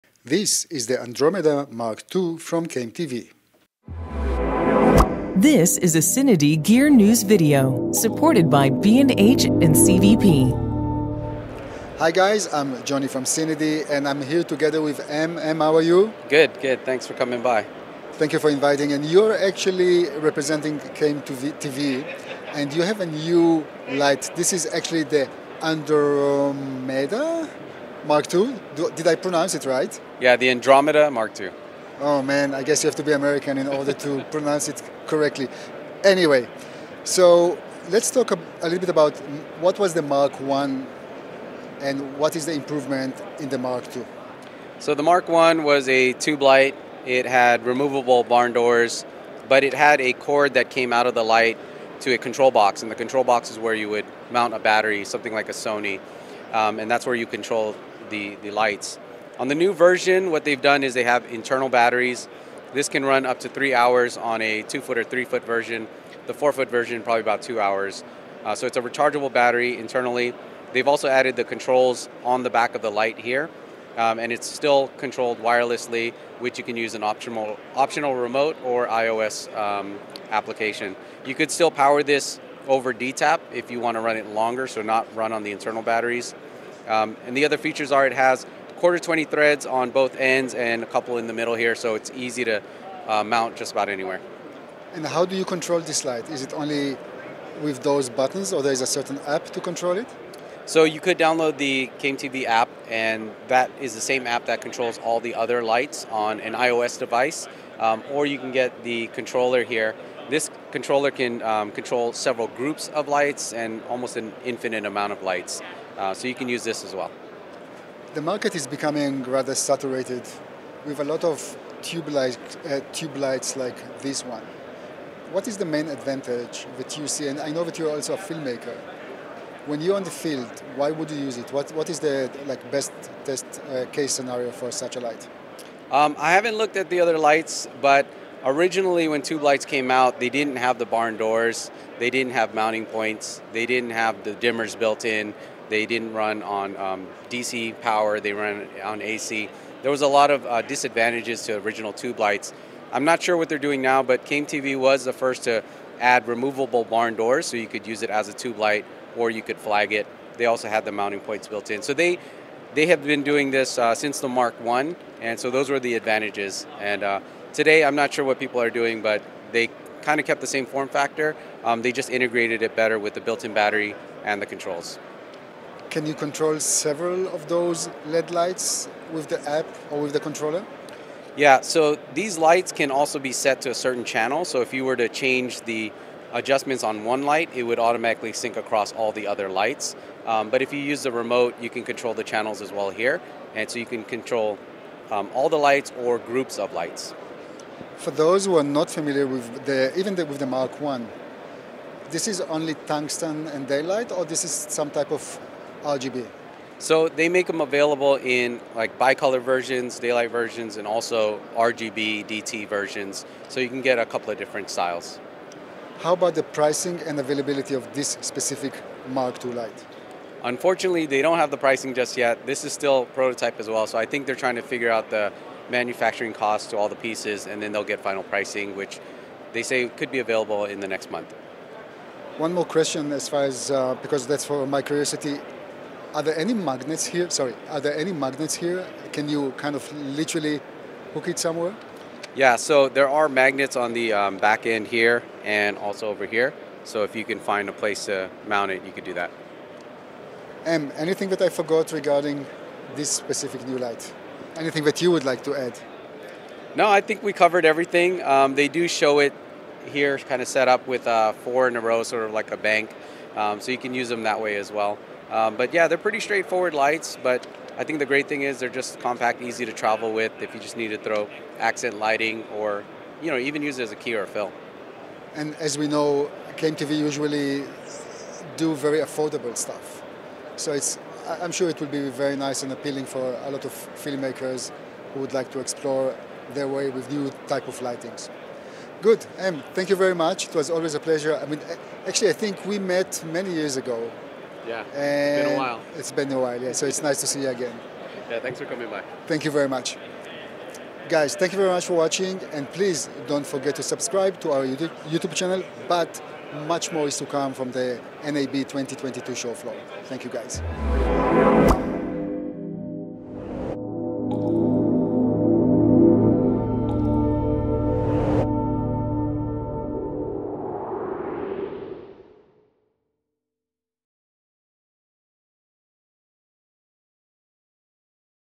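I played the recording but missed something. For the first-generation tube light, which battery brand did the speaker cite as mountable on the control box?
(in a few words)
Sony.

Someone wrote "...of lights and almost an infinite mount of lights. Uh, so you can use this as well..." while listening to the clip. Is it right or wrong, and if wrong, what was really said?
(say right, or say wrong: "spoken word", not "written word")
wrong: "amount", not "mount".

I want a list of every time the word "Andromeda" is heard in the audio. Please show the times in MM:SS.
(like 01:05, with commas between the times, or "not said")
00:01, 00:25, 00:30.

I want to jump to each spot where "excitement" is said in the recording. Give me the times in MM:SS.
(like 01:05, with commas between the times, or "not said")
not said.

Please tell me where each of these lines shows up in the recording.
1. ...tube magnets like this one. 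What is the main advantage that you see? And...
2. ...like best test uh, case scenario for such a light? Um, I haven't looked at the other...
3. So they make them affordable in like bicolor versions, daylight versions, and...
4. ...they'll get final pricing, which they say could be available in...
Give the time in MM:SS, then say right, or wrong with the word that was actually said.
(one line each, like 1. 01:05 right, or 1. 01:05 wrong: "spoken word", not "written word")
1. 02:02 wrong: "lights", not "magnets"
2. 02:12 right
3. 03:26 wrong: "available", not "affordable"
4. 03:47 right.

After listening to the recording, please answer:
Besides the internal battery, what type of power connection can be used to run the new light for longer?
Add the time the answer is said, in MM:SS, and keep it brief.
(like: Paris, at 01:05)
DTAP, at 01:22.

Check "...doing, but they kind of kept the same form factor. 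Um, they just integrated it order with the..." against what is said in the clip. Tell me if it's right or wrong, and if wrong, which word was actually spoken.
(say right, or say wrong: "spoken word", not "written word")
wrong: "better", not "order".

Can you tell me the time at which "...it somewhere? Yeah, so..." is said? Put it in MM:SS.
04:01.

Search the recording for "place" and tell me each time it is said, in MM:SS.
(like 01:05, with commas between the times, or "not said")
04:07.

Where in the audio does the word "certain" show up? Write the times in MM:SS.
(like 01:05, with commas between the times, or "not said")
01:38, 03:03.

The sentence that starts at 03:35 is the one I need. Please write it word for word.
How about the pricing and availability of this specific Mark II light?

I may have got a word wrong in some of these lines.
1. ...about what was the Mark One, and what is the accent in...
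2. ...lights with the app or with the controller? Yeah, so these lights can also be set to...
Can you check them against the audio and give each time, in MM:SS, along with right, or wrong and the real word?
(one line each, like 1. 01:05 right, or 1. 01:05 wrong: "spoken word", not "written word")
1. 00:38 wrong: "improvement", not "accent"
2. 02:58 right.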